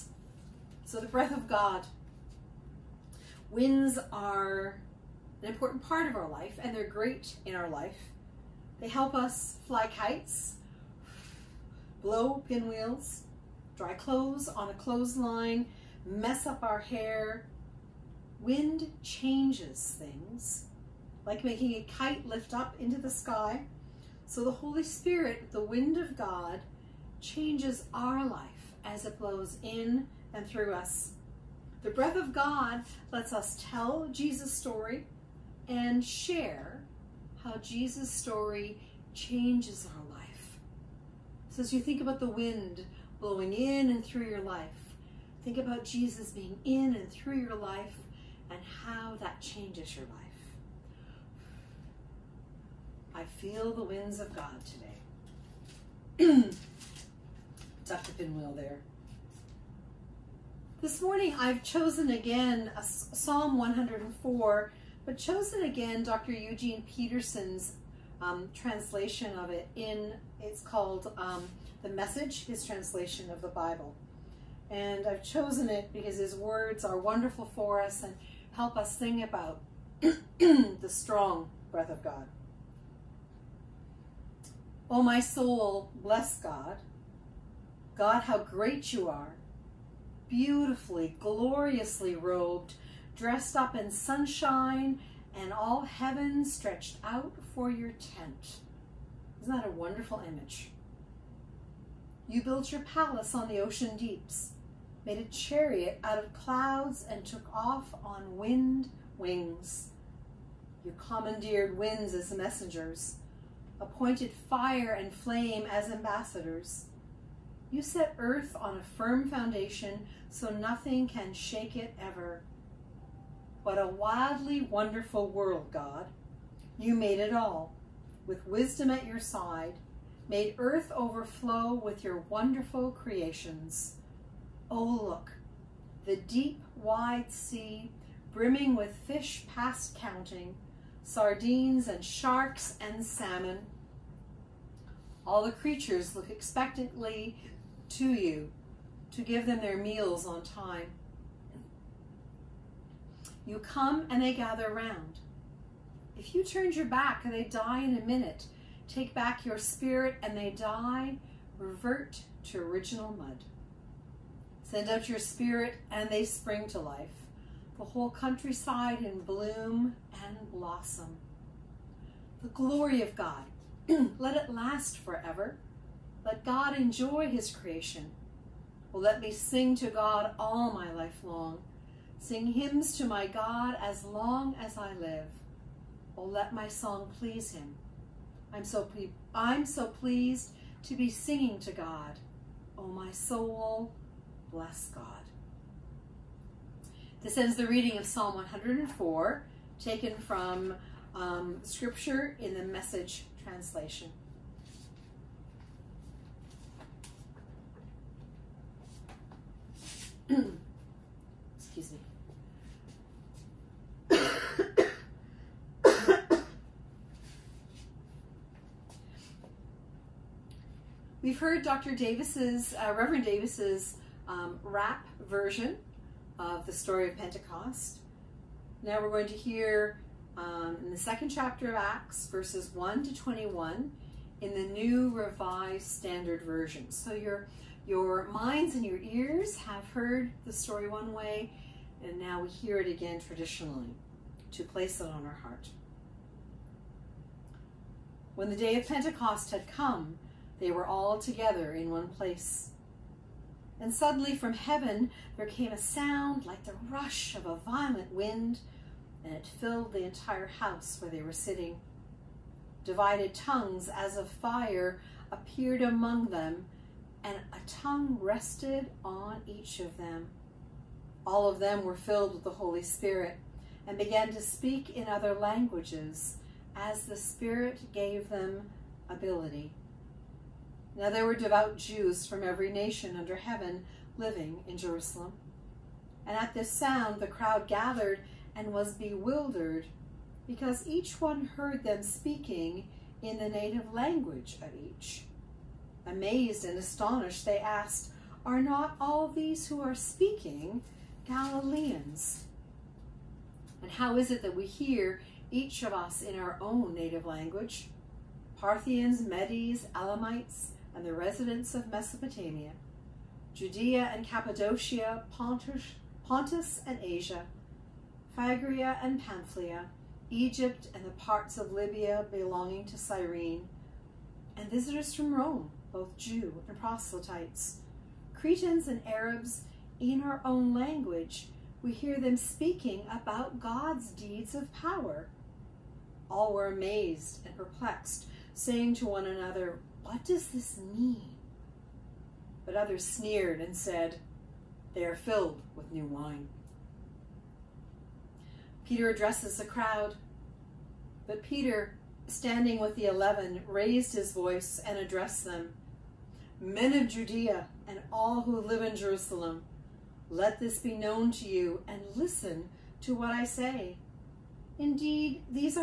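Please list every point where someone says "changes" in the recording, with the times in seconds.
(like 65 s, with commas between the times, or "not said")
19 s, 27 s, 39 s, 49 s.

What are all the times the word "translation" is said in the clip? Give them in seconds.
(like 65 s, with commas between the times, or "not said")
68 s, 72 s, 203 s.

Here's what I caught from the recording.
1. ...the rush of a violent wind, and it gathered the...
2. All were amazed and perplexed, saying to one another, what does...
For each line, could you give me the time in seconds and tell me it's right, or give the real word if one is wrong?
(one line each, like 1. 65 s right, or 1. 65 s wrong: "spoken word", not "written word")
1. 256 s wrong: "filled", not "gathered"
2. 336 s right.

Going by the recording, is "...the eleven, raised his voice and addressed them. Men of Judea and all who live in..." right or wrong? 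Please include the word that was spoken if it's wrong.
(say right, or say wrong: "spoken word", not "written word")
right.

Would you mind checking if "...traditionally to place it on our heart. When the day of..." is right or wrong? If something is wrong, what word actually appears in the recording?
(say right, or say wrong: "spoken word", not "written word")
right.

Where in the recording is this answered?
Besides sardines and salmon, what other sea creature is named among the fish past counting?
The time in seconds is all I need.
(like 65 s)
142 s.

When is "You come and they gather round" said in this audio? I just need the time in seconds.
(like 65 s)
153 s.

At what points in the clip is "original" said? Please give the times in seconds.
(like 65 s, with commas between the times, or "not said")
162 s.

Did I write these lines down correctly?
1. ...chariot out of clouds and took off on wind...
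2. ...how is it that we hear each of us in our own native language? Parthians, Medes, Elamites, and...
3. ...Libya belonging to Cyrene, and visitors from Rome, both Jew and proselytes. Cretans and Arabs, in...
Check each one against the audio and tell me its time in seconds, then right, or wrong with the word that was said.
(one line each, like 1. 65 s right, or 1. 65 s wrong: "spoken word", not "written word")
1. 105 s right
2. 303 s right
3. 321 s right.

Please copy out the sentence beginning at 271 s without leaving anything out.
All of them were filled with the Holy Spirit and began to speak in other languages as the Spirit gave them ability.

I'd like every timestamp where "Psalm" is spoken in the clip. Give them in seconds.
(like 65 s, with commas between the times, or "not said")
62 s, 198 s.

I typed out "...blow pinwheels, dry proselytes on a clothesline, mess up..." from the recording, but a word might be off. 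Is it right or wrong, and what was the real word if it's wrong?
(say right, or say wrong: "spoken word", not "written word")
wrong: "clothes", not "proselytes".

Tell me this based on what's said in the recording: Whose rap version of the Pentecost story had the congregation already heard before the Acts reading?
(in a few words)
Reverend Davis.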